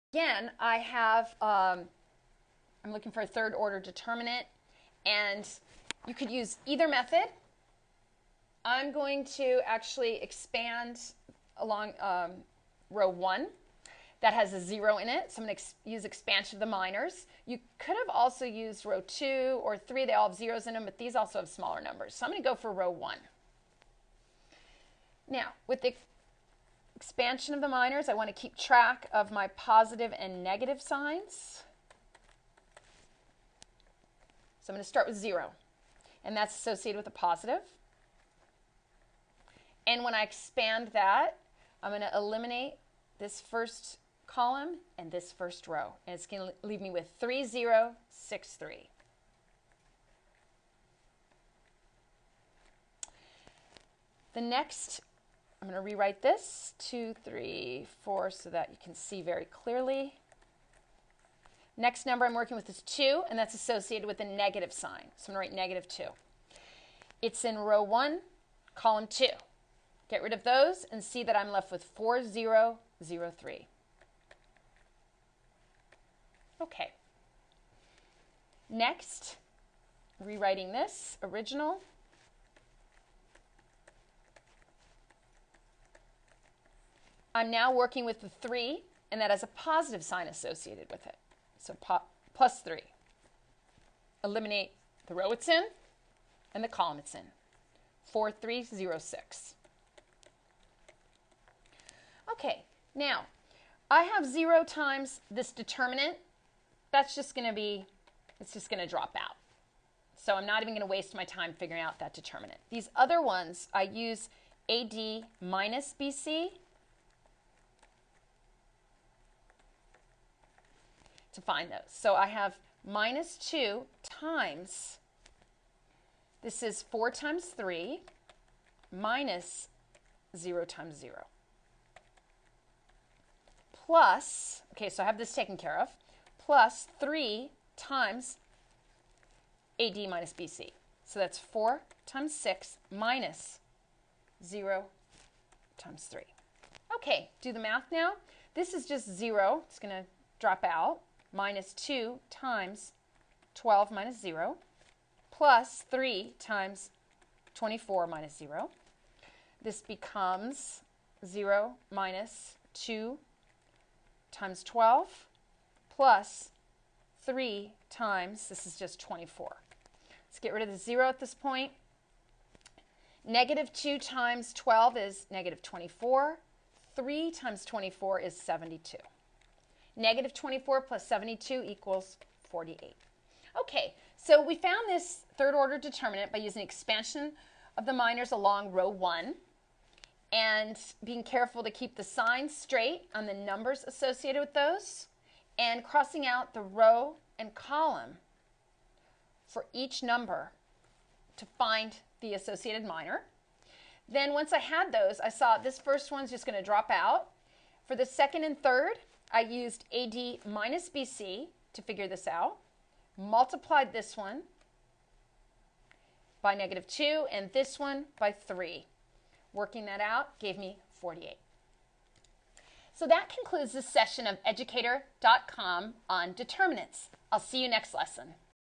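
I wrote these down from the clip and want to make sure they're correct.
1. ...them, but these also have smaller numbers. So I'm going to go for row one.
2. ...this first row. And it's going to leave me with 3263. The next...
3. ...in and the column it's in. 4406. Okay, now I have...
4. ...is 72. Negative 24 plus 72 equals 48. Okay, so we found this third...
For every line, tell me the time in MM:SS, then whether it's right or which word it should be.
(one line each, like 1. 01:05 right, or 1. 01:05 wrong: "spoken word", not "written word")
1. 00:20 right
2. 00:45 wrong: "3063", not "3263"
3. 01:35 wrong: "4306", not "4406"
4. 02:58 right.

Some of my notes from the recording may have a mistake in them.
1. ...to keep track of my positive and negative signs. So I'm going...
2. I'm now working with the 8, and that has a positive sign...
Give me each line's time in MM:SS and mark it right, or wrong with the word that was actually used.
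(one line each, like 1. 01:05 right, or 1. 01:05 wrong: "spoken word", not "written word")
1. 00:28 right
2. 01:27 wrong: "3", not "8".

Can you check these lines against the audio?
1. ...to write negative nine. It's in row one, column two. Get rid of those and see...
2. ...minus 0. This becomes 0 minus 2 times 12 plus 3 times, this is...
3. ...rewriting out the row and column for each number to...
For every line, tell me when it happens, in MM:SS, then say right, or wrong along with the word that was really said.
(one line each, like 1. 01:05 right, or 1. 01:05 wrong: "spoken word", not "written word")
1. 01:05 wrong: "two", not "nine"
2. 02:38 right
3. 03:15 wrong: "crossing", not "rewriting".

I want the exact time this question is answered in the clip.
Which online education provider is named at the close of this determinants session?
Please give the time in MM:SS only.
03:44.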